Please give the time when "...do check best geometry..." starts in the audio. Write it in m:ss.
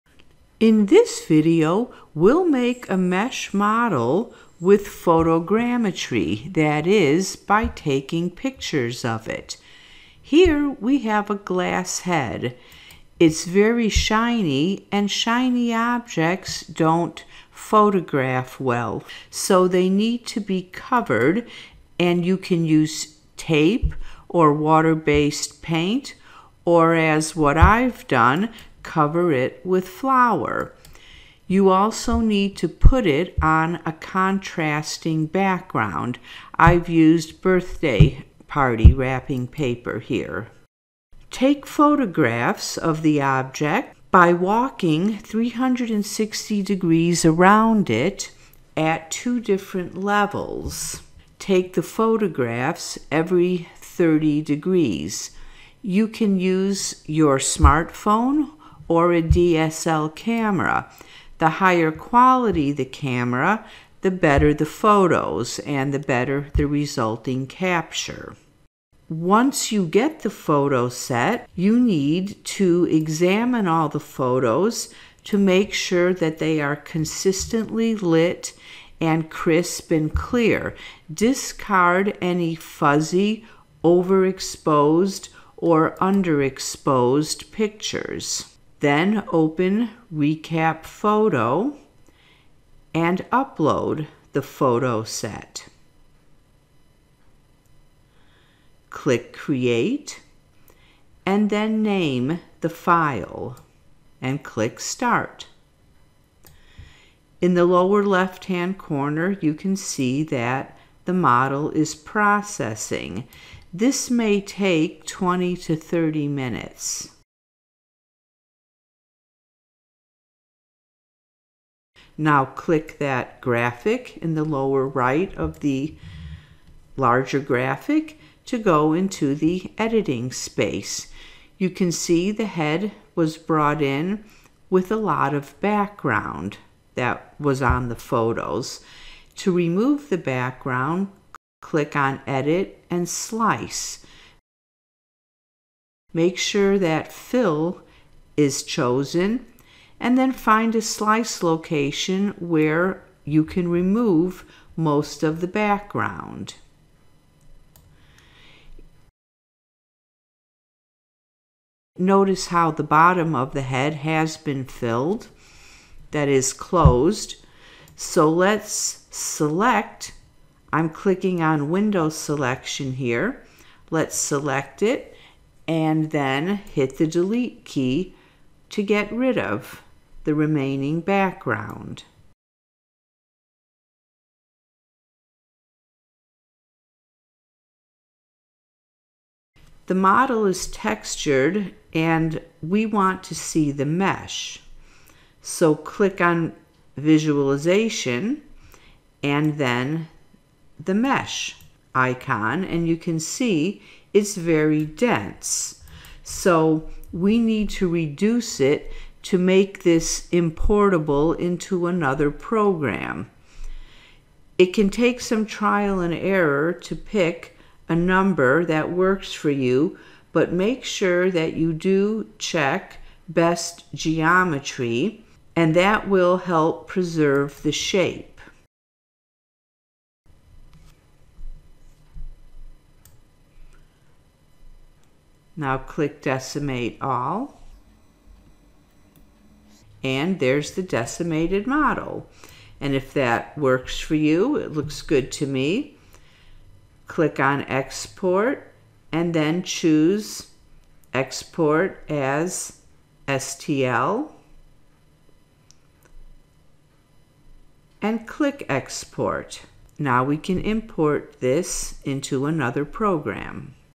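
3:41.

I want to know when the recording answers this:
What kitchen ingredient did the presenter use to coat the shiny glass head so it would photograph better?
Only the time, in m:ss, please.
0:29.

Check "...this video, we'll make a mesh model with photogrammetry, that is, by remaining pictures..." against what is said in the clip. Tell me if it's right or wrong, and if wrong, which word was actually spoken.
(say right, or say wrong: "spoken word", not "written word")
wrong: "taking", not "remaining".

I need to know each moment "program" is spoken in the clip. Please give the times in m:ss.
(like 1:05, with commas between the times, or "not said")
3:32, 4:22.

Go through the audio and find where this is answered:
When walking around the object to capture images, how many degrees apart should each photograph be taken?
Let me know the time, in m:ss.
0:53.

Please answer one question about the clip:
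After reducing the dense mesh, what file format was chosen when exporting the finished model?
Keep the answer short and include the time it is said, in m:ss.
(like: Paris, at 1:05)
STL, at 4:13.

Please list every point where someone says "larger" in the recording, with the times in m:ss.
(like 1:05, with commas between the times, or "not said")
2:06.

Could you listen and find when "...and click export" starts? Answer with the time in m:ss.
4:18.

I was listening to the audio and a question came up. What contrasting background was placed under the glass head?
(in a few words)
Birthday party wrapping paper.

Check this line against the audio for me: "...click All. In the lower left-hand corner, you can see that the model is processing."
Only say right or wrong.
wrong.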